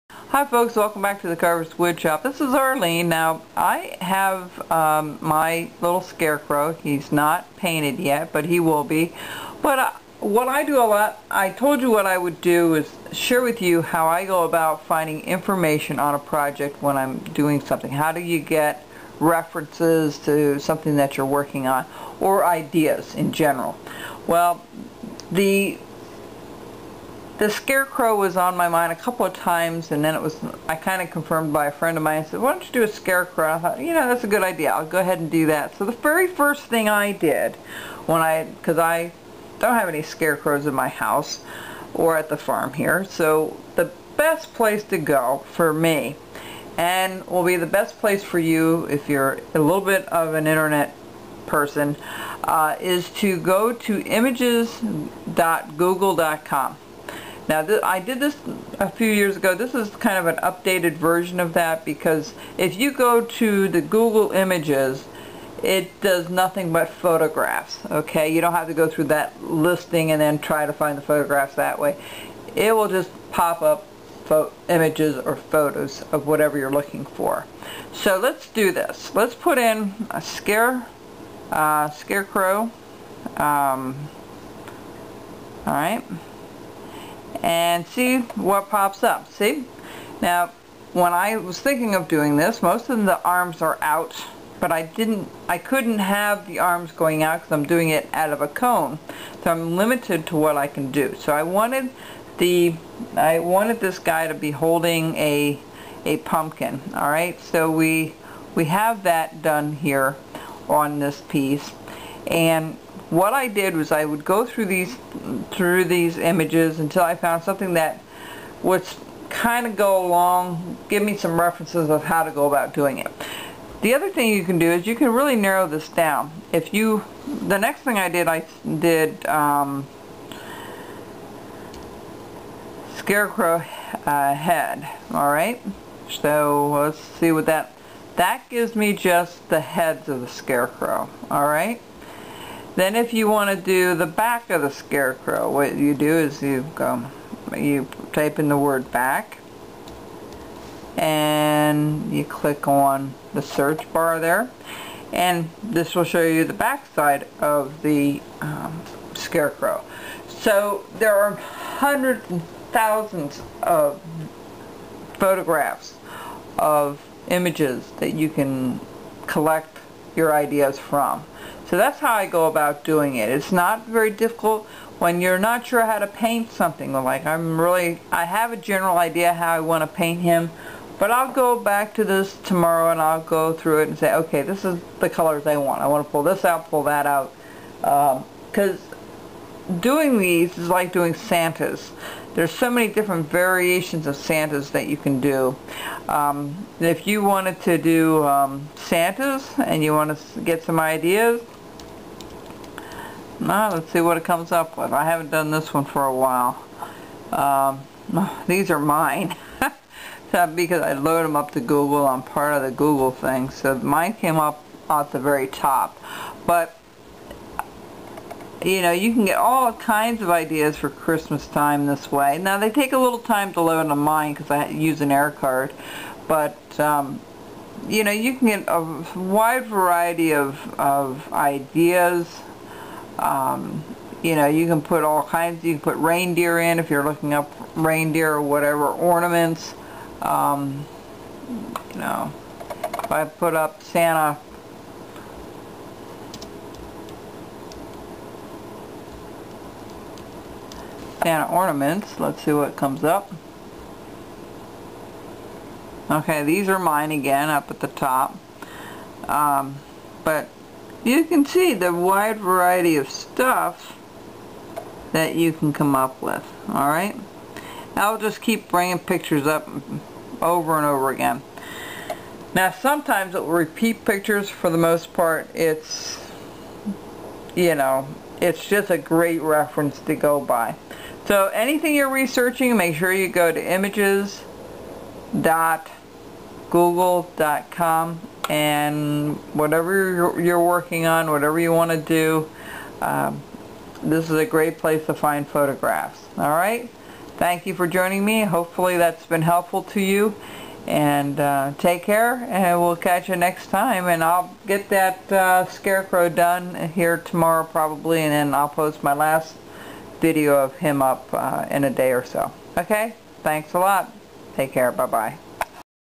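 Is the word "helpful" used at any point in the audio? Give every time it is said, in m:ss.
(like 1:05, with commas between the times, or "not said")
4:59.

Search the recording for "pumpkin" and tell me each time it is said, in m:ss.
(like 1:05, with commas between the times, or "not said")
1:46.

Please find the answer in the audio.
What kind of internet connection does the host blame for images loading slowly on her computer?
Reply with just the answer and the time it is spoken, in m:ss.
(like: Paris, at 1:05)
air card, at 3:45.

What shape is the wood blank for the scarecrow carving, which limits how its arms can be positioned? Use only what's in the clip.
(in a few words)
cone.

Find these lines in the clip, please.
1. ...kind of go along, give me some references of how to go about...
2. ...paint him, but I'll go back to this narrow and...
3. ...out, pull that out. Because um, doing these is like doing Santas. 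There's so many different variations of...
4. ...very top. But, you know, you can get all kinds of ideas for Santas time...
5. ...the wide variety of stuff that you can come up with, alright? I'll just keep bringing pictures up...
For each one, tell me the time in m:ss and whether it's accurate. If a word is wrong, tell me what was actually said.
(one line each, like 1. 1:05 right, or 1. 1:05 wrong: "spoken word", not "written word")
1. 1:59 right
2. 2:59 wrong: "tomorrow", not "narrow"
3. 3:06 right
4. 3:35 wrong: "Christmas", not "Santas"
5. 4:21 right.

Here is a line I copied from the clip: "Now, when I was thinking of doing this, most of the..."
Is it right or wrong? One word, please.
right.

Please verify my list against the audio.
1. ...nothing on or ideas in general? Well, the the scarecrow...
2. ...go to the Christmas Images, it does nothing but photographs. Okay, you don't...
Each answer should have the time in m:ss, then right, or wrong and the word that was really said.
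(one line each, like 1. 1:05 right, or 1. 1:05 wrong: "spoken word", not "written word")
1. 0:21 wrong: "working", not "nothing"
2. 1:02 wrong: "Google", not "Christmas".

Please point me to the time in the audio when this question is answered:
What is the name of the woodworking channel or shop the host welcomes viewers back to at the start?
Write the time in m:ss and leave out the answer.
0:01.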